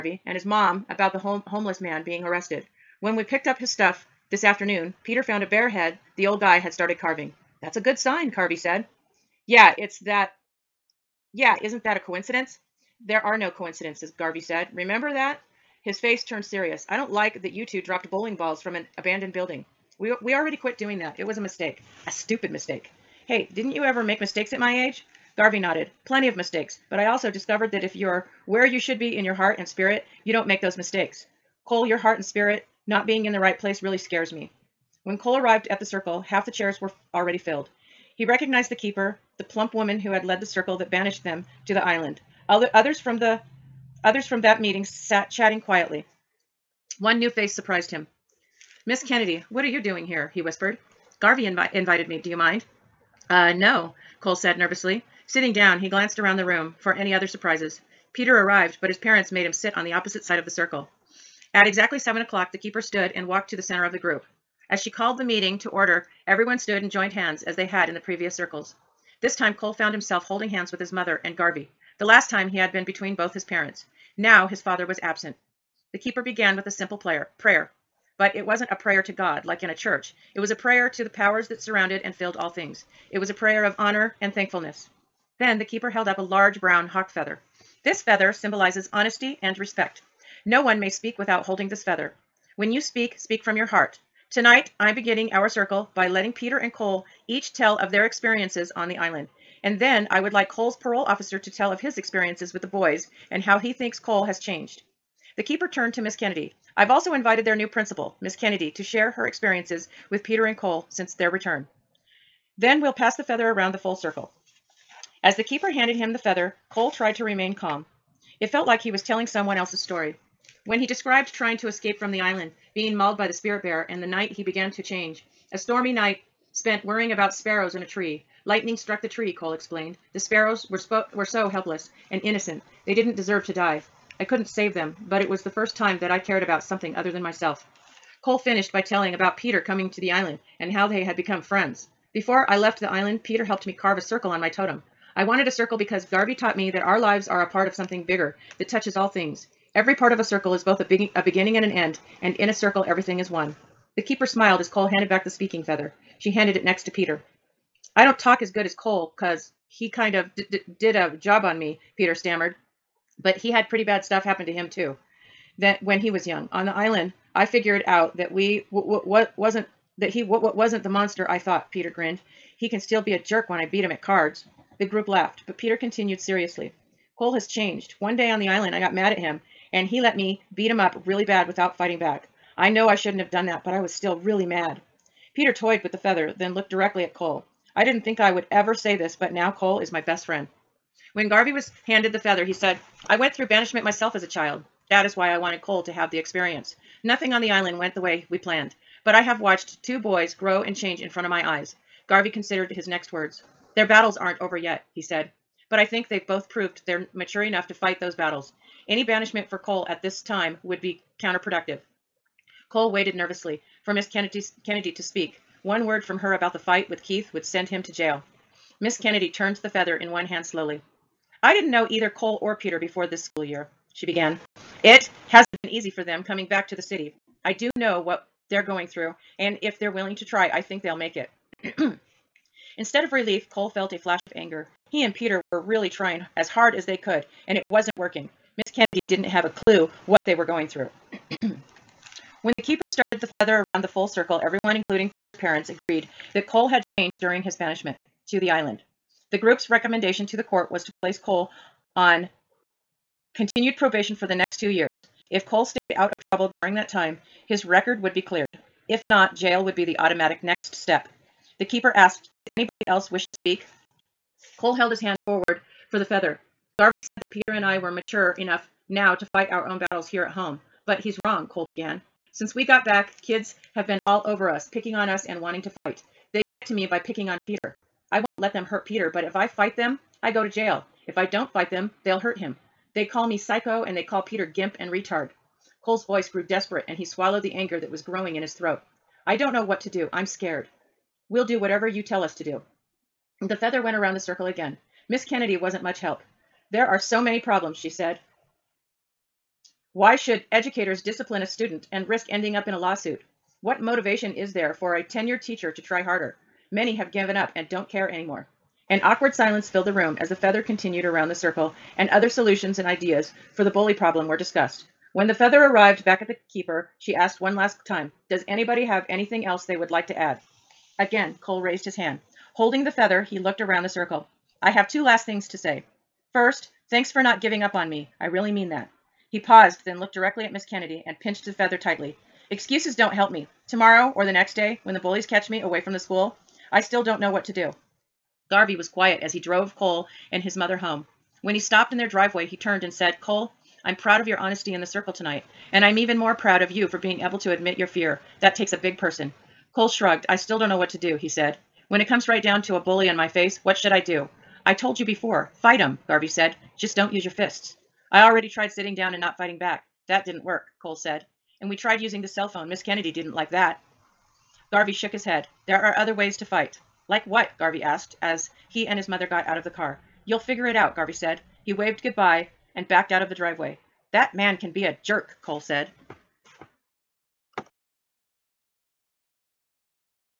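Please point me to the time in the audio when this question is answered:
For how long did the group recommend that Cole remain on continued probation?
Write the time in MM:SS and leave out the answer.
04:14.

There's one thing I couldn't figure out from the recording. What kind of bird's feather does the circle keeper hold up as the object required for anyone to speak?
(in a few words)
Hawk feather.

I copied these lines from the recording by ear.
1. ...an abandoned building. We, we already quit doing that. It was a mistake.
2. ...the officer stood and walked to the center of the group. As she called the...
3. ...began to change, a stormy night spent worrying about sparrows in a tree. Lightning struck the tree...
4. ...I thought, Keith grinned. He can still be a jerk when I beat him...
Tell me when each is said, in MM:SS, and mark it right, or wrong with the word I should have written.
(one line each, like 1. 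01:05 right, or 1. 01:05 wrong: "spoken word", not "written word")
1. 00:18 right
2. 01:02 wrong: "keeper", not "officer"
3. 02:04 right
4. 02:51 wrong: "Peter", not "Keith".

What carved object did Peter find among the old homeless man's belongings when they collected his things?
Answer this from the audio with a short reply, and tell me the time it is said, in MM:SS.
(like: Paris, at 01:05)
Bear head, at 00:05.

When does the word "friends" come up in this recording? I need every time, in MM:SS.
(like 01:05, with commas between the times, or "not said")
02:21, 03:10.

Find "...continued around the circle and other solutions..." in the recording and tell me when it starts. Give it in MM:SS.
05:10.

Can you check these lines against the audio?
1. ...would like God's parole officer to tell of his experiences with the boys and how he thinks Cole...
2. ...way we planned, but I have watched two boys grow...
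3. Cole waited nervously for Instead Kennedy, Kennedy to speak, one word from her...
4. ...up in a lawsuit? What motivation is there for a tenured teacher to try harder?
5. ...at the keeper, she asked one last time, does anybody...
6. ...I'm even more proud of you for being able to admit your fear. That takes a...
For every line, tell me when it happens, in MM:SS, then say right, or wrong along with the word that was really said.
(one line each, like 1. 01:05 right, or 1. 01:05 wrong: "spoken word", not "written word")
1. 01:40 wrong: "Cole", not "God"
2. 03:17 right
3. 03:32 wrong: "Miss", not "Instead"
4. 05:02 right
5. 05:16 right
6. 05:45 right.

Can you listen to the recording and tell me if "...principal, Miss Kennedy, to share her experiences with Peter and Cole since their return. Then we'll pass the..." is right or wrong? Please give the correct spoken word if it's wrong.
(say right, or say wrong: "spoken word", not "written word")
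right.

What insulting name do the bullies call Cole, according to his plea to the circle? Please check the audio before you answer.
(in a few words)
Psycho.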